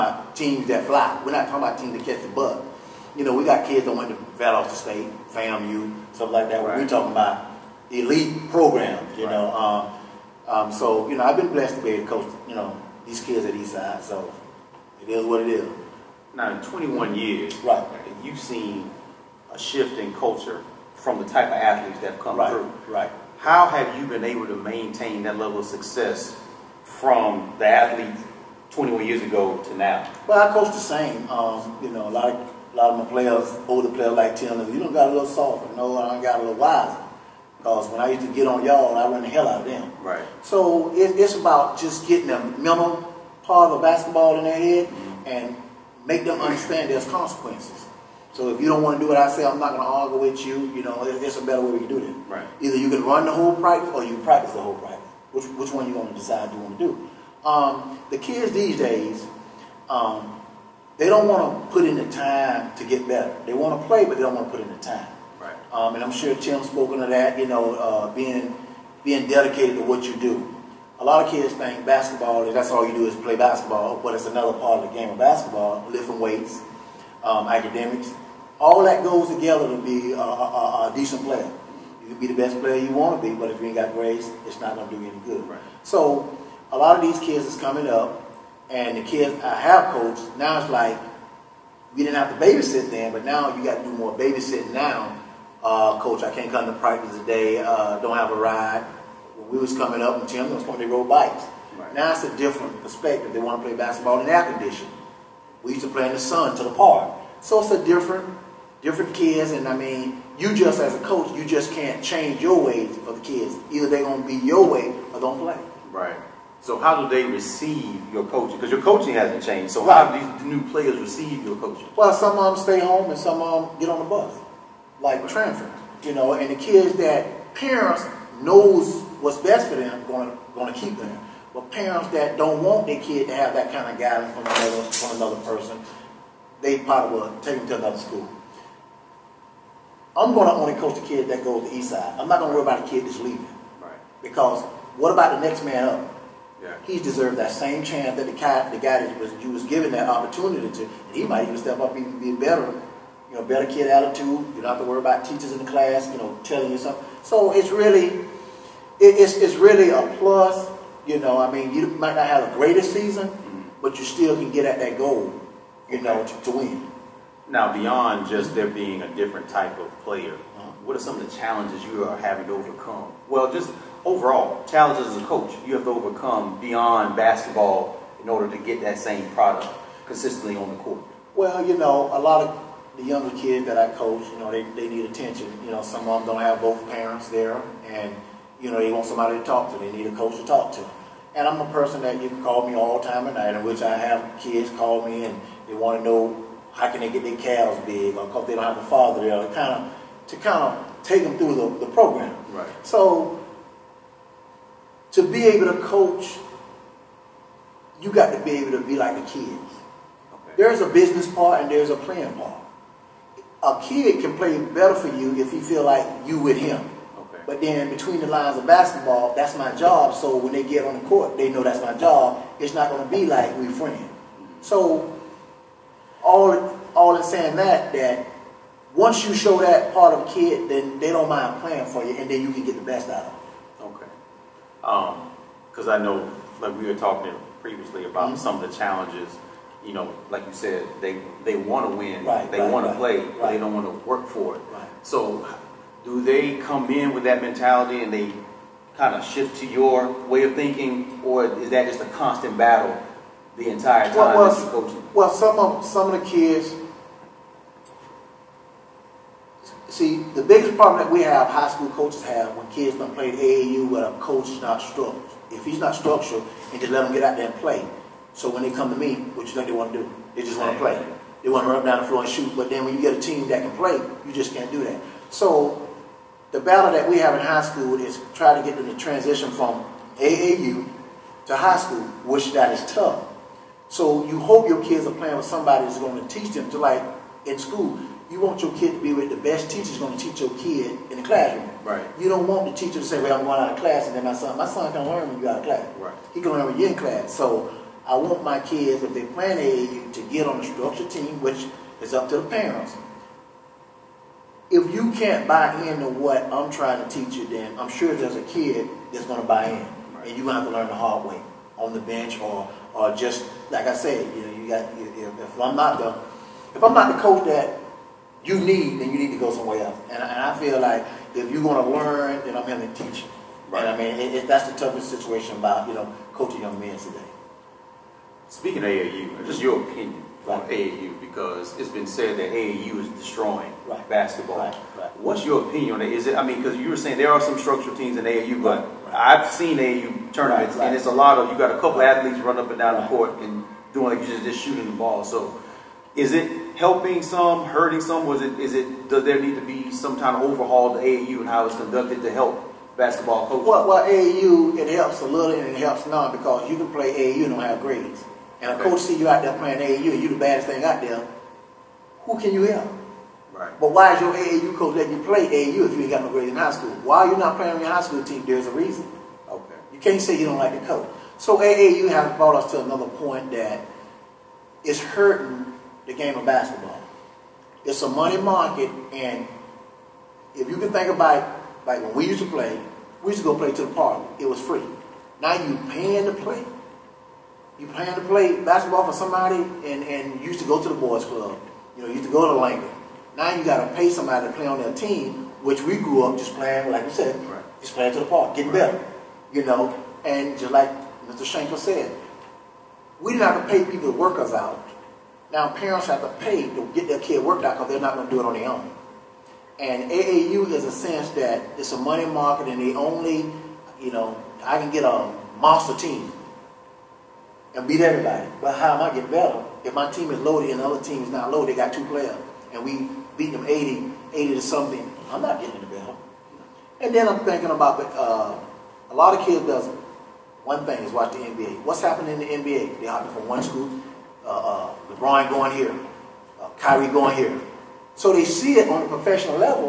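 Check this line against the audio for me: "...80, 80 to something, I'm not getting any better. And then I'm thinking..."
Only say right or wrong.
right.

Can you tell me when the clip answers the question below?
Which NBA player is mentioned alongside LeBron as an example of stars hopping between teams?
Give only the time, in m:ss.
7:16.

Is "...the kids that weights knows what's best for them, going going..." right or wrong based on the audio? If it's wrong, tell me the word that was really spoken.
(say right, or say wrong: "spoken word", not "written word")
wrong: "parents", not "weights".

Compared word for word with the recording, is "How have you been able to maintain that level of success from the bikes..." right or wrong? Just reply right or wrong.
wrong.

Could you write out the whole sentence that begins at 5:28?
Speaking of AAU, just your opinion right.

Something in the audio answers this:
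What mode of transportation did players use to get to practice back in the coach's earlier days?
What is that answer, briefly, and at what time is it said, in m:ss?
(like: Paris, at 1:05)
Bikes, at 1:40.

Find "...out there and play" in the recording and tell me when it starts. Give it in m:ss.
4:27.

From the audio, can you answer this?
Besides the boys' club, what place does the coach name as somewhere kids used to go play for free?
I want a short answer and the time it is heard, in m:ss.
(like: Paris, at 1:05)
Langley, at 6:32.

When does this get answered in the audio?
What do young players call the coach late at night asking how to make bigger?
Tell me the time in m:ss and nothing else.
3:17.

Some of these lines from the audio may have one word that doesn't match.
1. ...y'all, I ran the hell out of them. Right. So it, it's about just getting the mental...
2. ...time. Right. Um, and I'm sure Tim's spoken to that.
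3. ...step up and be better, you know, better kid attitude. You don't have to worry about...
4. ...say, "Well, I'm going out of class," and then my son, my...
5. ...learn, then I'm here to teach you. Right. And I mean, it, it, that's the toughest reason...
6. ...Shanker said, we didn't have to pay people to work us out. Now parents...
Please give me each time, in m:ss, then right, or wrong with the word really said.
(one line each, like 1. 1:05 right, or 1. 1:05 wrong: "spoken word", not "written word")
1. 0:38 right
2. 1:04 right
3. 2:31 right
4. 4:53 right
5. 5:21 wrong: "situation", not "reason"
6. 6:41 right.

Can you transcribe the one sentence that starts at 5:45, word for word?
So is it helping some, hurting some?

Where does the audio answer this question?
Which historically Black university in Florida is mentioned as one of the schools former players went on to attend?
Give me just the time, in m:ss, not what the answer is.
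0:05.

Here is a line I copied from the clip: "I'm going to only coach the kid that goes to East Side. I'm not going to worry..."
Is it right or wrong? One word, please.
right.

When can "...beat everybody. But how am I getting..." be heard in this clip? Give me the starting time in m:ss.
6:57.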